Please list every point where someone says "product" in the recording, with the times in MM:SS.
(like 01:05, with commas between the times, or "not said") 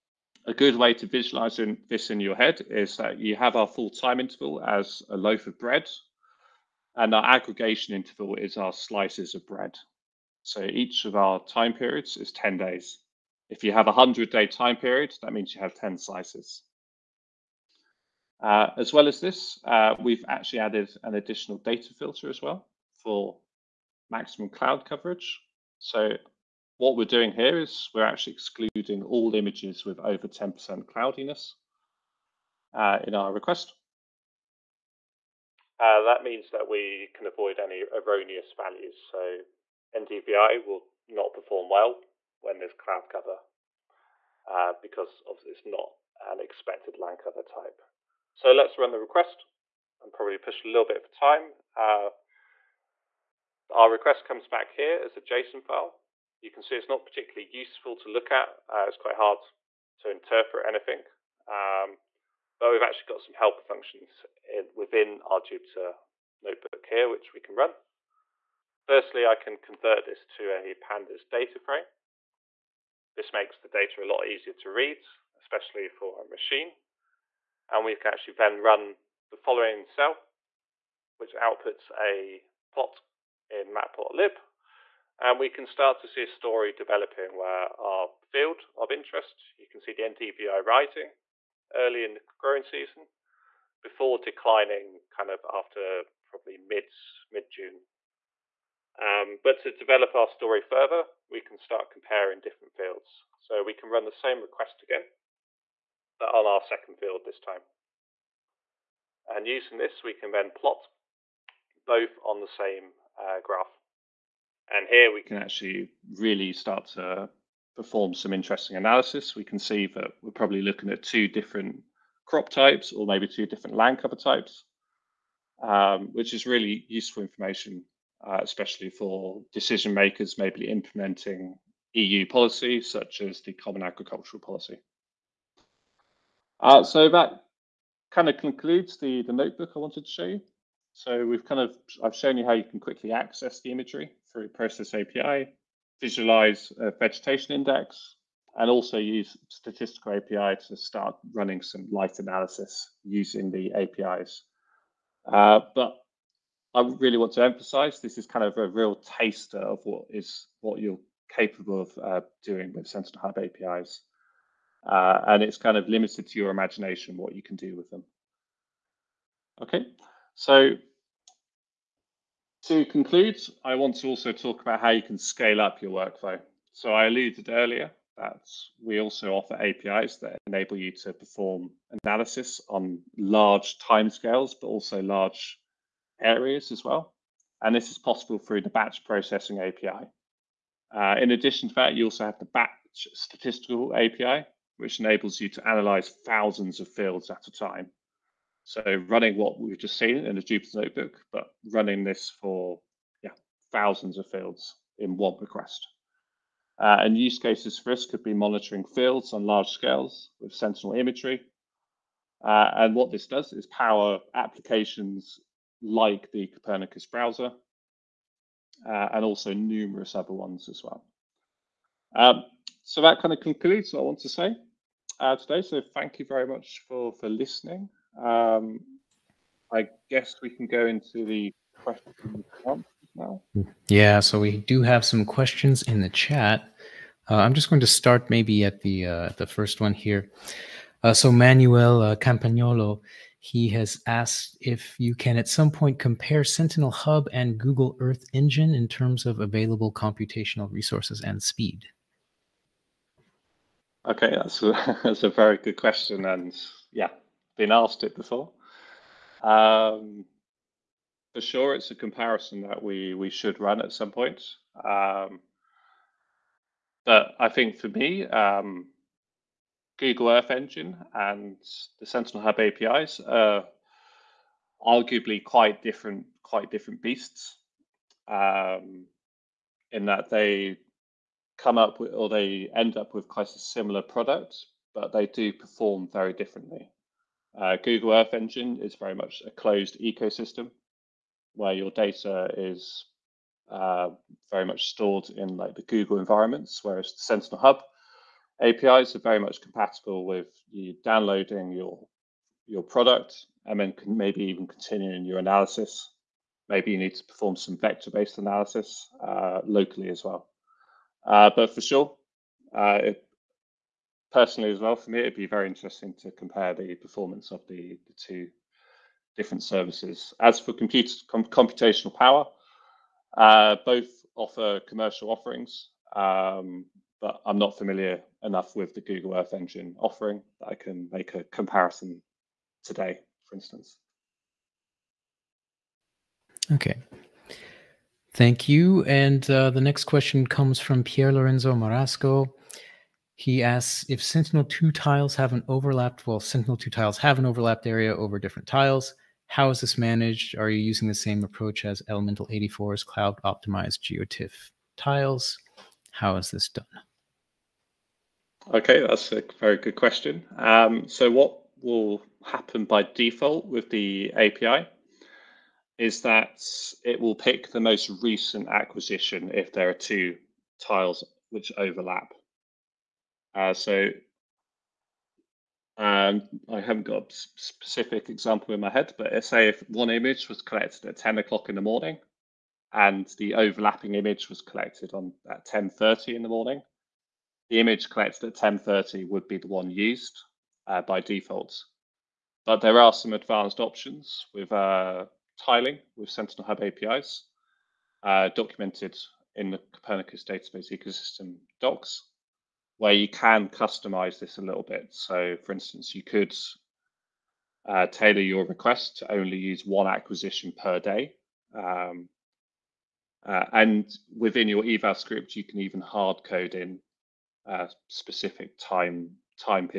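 04:44, 05:02.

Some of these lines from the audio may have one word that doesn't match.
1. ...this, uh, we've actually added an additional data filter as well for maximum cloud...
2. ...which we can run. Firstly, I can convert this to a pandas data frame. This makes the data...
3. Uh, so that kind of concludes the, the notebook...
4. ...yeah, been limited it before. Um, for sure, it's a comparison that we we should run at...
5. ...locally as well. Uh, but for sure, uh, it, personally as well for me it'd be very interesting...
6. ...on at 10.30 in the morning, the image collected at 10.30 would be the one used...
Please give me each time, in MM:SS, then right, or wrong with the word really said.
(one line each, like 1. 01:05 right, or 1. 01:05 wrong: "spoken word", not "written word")
1. 00:19 right
2. 01:07 right
3. 02:16 right
4. 04:16 wrong: "asked", not "limited"
5. 05:09 right
6. 06:25 right.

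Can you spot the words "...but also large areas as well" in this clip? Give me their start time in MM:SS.
03:04.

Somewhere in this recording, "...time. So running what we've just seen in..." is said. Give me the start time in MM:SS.
03:17.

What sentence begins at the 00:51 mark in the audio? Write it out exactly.
Uh, our request comes back here as a JSON file you can see it's not particularly useful to look at.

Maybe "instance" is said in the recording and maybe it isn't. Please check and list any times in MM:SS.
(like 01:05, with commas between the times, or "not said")
05:33, 06:45.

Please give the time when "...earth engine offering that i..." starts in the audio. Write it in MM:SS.
05:29.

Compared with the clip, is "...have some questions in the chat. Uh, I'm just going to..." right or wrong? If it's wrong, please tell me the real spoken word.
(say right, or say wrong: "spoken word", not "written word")
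right.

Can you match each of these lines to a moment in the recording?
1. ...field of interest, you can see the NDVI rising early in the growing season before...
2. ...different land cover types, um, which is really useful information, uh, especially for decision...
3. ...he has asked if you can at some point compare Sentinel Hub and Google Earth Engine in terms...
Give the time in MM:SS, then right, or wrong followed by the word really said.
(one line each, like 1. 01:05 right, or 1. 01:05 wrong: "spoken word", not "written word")
1. 01:28 right
2. 02:03 right
3. 04:03 right.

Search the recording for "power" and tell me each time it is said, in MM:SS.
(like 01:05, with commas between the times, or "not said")
03:33, 05:22.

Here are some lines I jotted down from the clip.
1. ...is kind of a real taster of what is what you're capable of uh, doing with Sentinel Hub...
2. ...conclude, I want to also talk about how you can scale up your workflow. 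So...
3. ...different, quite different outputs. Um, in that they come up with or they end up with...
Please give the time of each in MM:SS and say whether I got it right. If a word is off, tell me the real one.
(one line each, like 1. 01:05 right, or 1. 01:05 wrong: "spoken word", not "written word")
1. 02:38 right
2. 02:52 right
3. 04:35 wrong: "beasts", not "outputs".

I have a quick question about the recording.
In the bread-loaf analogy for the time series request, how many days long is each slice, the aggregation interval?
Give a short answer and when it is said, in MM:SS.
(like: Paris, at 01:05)
10 days, at 00:12.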